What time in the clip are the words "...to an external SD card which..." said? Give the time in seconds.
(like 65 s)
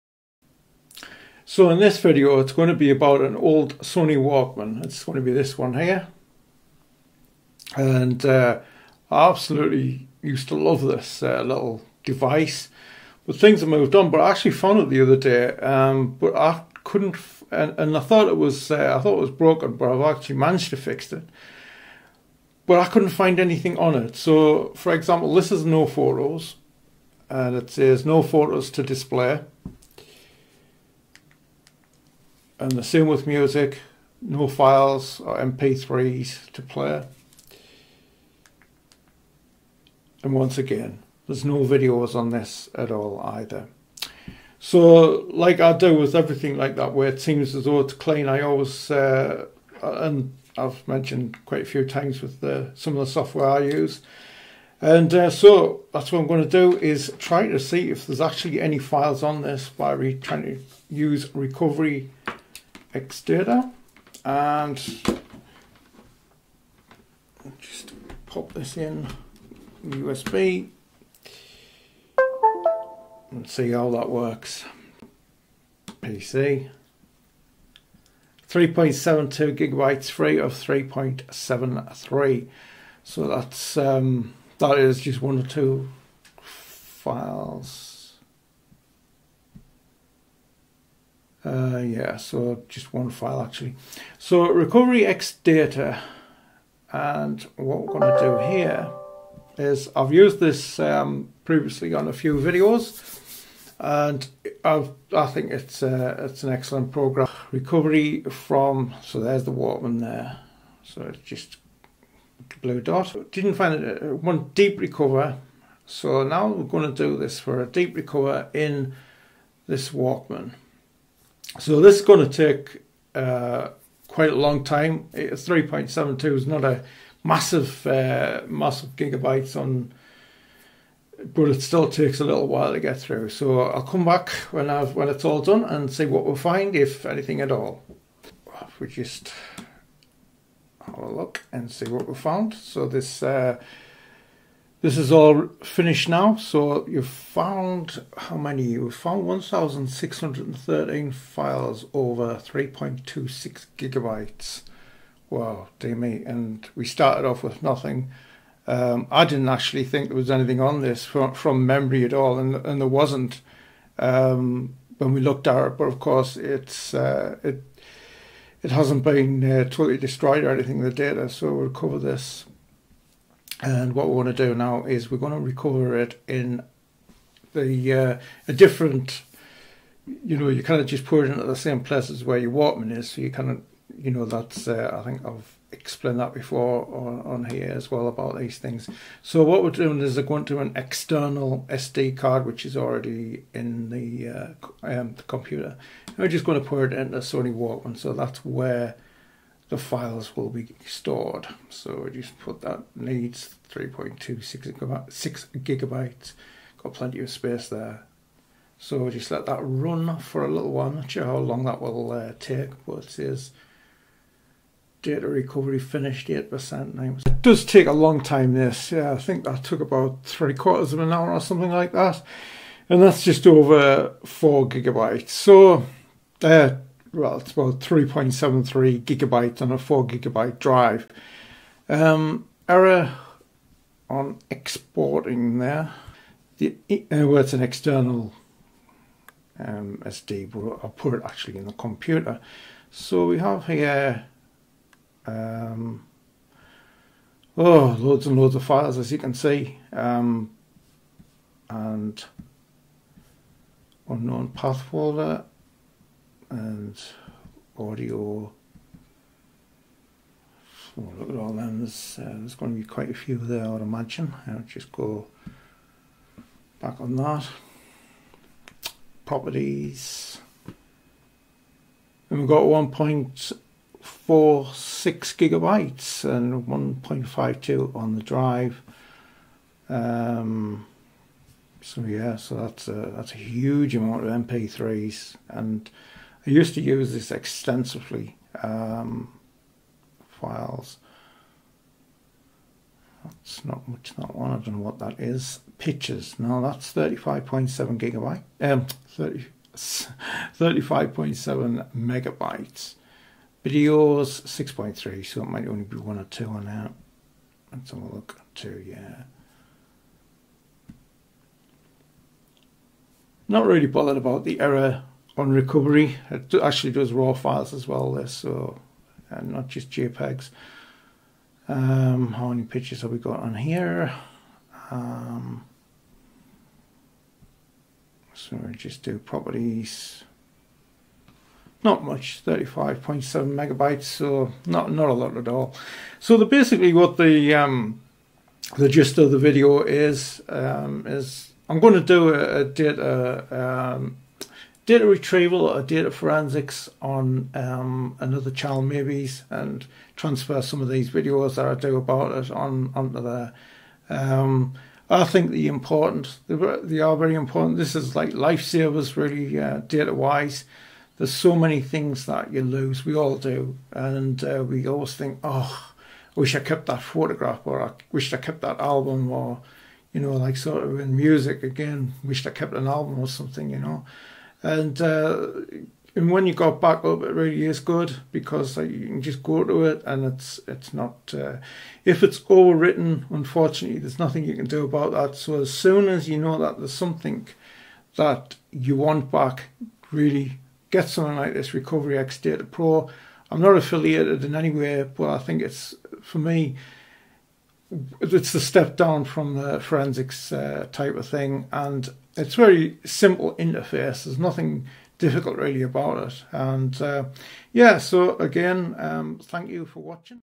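190 s.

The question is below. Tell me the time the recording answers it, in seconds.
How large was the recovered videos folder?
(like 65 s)
304 s.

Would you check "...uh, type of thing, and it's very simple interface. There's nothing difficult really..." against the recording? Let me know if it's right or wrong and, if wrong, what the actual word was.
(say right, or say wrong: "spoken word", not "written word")
right.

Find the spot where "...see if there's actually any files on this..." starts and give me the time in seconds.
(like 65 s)
57 s.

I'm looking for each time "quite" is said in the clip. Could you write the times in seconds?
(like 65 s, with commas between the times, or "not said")
51 s, 124 s, 262 s.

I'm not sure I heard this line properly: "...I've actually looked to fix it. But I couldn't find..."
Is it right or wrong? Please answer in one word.
wrong.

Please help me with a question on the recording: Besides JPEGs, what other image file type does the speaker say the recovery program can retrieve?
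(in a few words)
raw files.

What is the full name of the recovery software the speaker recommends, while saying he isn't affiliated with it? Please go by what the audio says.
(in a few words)
Recovery X Data Pro.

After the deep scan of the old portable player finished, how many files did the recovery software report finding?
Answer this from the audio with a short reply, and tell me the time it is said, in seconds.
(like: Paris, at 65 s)
1,613, at 149 s.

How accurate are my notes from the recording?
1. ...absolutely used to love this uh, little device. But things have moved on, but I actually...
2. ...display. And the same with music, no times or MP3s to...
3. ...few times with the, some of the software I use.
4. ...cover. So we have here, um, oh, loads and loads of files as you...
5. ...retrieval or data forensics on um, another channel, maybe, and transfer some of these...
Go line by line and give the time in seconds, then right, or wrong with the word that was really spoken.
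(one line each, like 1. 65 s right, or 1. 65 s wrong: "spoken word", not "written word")
1. 9 s right
2. 28 s wrong: "files", not "times"
3. 51 s right
4. 241 s wrong: "computer", not "cover"
5. 345 s right.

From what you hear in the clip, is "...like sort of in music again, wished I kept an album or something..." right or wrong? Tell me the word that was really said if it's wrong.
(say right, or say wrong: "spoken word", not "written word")
right.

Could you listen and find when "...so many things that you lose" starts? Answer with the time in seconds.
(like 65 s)
361 s.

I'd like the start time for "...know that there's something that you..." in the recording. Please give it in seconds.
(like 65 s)
386 s.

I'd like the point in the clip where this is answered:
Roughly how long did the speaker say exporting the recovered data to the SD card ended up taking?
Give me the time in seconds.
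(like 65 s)
220 s.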